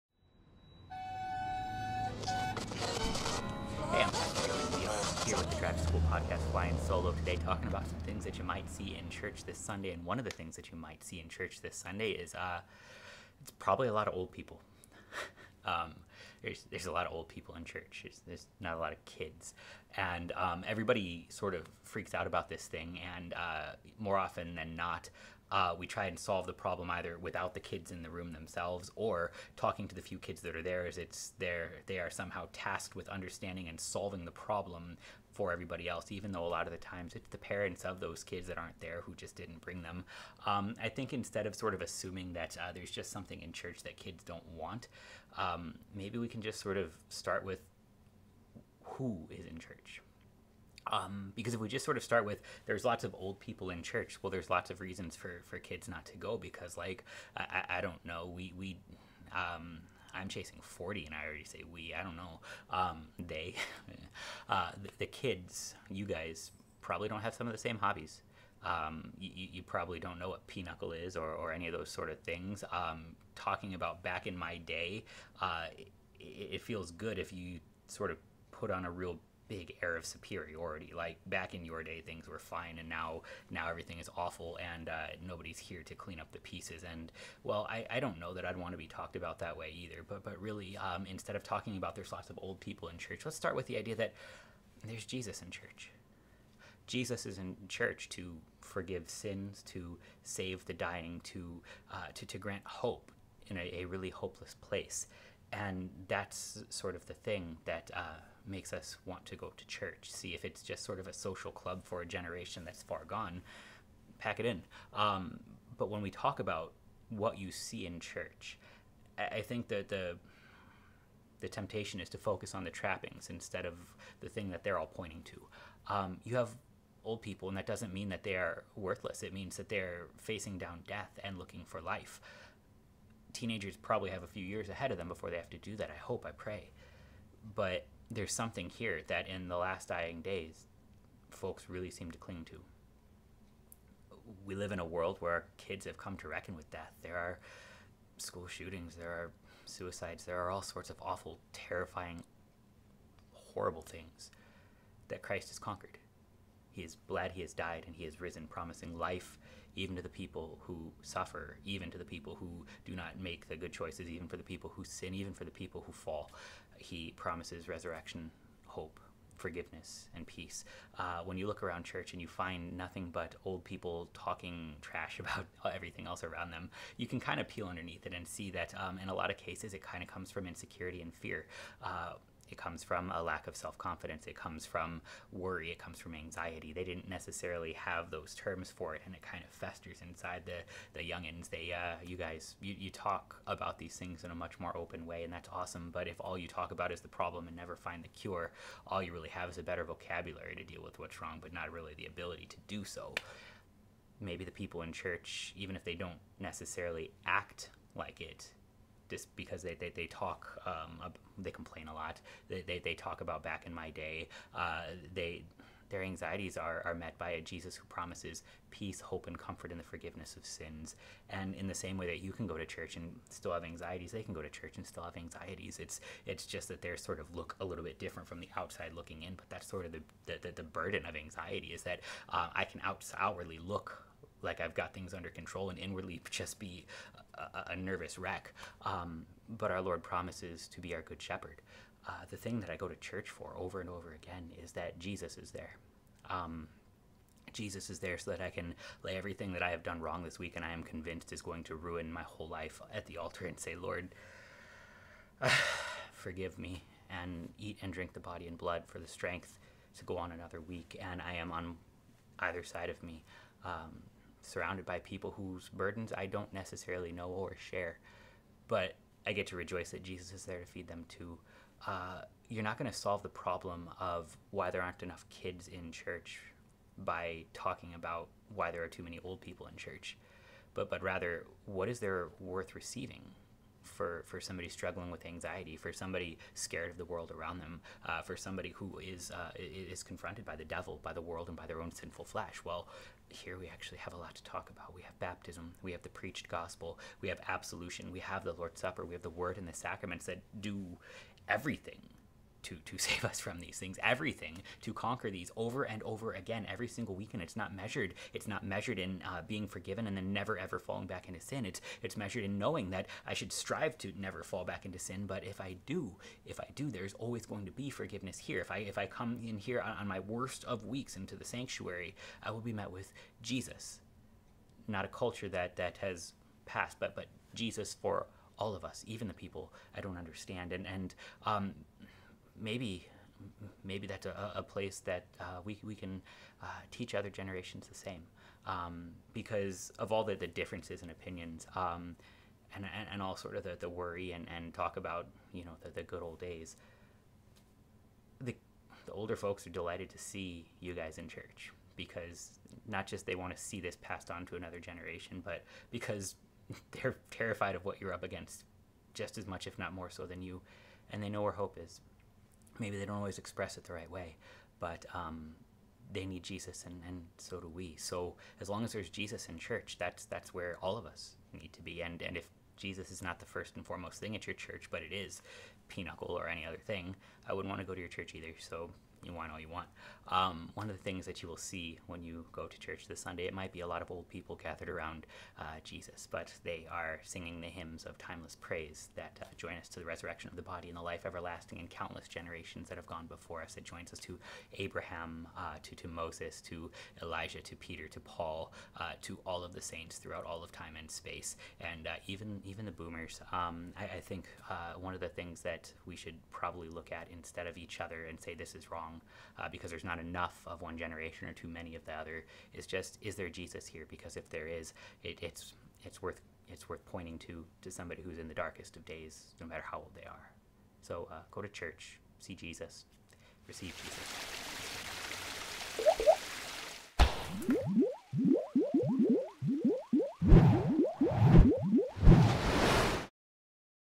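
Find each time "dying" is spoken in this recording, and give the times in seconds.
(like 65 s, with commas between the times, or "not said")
100 s, 139 s.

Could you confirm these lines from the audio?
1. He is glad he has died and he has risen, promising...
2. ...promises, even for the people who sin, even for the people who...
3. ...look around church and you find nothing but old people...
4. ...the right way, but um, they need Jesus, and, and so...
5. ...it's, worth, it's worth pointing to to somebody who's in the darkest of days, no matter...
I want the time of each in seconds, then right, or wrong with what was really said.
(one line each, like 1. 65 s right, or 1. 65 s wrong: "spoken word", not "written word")
1. 156 s right
2. 163 s wrong: "choices", not "promises"
3. 171 s right
4. 363 s right
5. 416 s right.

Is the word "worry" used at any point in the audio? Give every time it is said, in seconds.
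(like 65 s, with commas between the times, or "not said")
185 s, 343 s.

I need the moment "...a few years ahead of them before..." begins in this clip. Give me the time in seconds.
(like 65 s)
134 s.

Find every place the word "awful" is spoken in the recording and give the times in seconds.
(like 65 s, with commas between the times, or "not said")
84 s, 151 s.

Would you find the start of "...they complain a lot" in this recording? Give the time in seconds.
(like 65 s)
211 s.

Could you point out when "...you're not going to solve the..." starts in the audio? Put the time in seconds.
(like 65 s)
272 s.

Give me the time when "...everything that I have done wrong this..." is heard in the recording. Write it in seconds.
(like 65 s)
249 s.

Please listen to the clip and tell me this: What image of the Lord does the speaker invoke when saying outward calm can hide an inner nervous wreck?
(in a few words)
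good shepherd.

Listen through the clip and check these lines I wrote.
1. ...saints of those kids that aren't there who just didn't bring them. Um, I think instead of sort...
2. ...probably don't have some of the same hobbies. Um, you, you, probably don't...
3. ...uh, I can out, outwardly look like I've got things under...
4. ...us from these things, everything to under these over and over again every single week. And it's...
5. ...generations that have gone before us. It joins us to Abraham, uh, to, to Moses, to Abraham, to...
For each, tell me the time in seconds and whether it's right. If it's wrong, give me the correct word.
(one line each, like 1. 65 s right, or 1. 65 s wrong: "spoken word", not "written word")
1. 37 s wrong: "parents", not "saints"
2. 66 s right
3. 232 s right
4. 303 s wrong: "conquer", not "under"
5. 392 s wrong: "Elijah", not "Abraham".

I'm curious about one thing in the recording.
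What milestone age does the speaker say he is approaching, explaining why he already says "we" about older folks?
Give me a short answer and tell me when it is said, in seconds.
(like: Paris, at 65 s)
40, at 60 s.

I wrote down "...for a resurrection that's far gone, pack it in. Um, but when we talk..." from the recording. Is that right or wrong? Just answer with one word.
wrong.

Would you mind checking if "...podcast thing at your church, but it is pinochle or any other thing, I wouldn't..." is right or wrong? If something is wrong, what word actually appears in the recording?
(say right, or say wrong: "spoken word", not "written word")
wrong: "foremost", not "podcast".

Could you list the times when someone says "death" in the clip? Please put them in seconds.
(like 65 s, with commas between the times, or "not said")
130 s, 146 s.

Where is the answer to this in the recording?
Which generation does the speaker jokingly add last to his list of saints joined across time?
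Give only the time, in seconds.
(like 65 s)
402 s.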